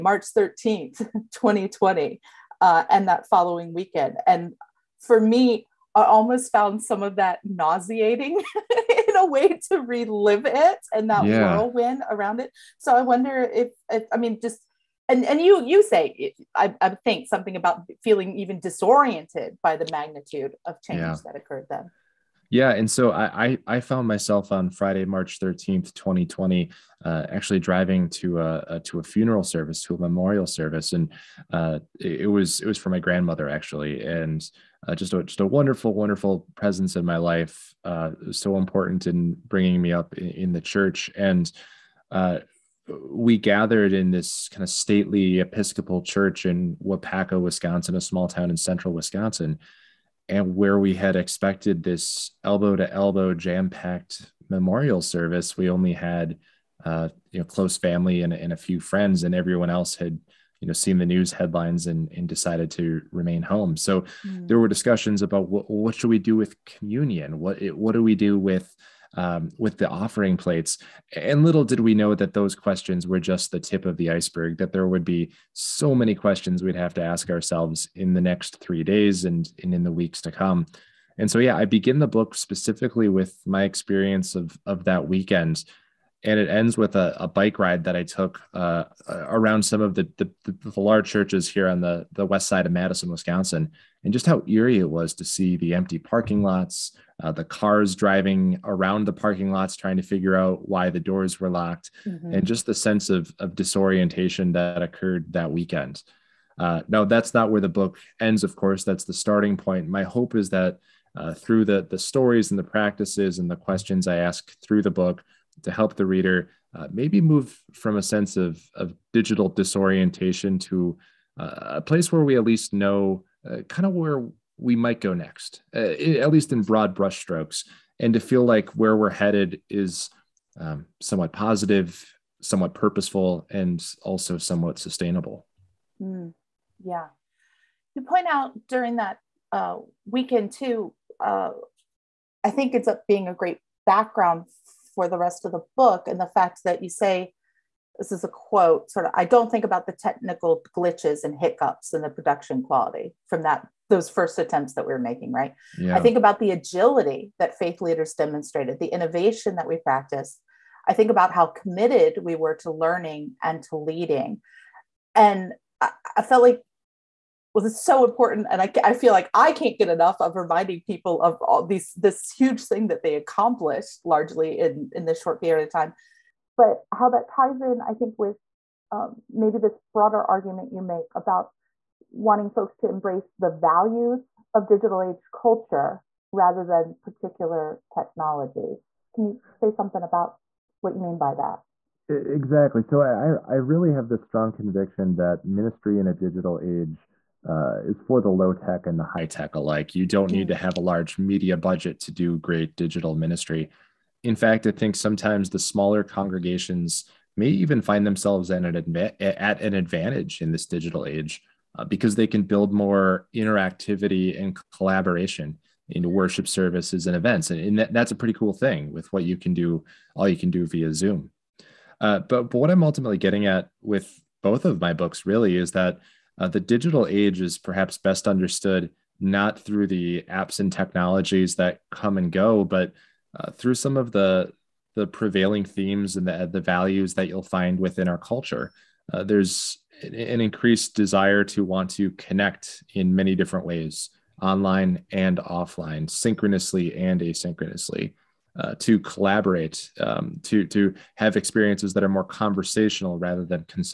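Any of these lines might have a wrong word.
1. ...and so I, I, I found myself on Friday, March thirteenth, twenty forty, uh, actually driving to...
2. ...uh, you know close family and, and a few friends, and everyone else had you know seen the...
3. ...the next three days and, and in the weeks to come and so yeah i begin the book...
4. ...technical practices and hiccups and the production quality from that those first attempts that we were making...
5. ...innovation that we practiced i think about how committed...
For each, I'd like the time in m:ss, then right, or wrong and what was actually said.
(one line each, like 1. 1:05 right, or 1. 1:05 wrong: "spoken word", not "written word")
1. 0:22 wrong: "twenty", not "forty"
2. 0:56 right
3. 1:18 right
4. 2:29 wrong: "glitches", not "practices"
5. 2:38 right.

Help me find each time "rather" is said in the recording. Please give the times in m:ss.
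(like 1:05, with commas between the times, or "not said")
3:06, 4:13.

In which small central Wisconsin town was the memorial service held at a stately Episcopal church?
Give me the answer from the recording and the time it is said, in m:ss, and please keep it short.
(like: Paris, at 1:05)
Waupaca, at 0:46.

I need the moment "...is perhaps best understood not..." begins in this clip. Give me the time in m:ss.
3:47.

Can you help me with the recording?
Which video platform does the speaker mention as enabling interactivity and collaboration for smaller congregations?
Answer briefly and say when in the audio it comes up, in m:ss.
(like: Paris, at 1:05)
Zoom, at 3:40.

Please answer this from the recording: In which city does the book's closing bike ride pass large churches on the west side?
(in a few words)
Madison, Wisconsin.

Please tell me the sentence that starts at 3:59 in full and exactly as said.
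Uh, there's an increased desire to want to connect in many different ways, online and offline, synchronously and asynchronously.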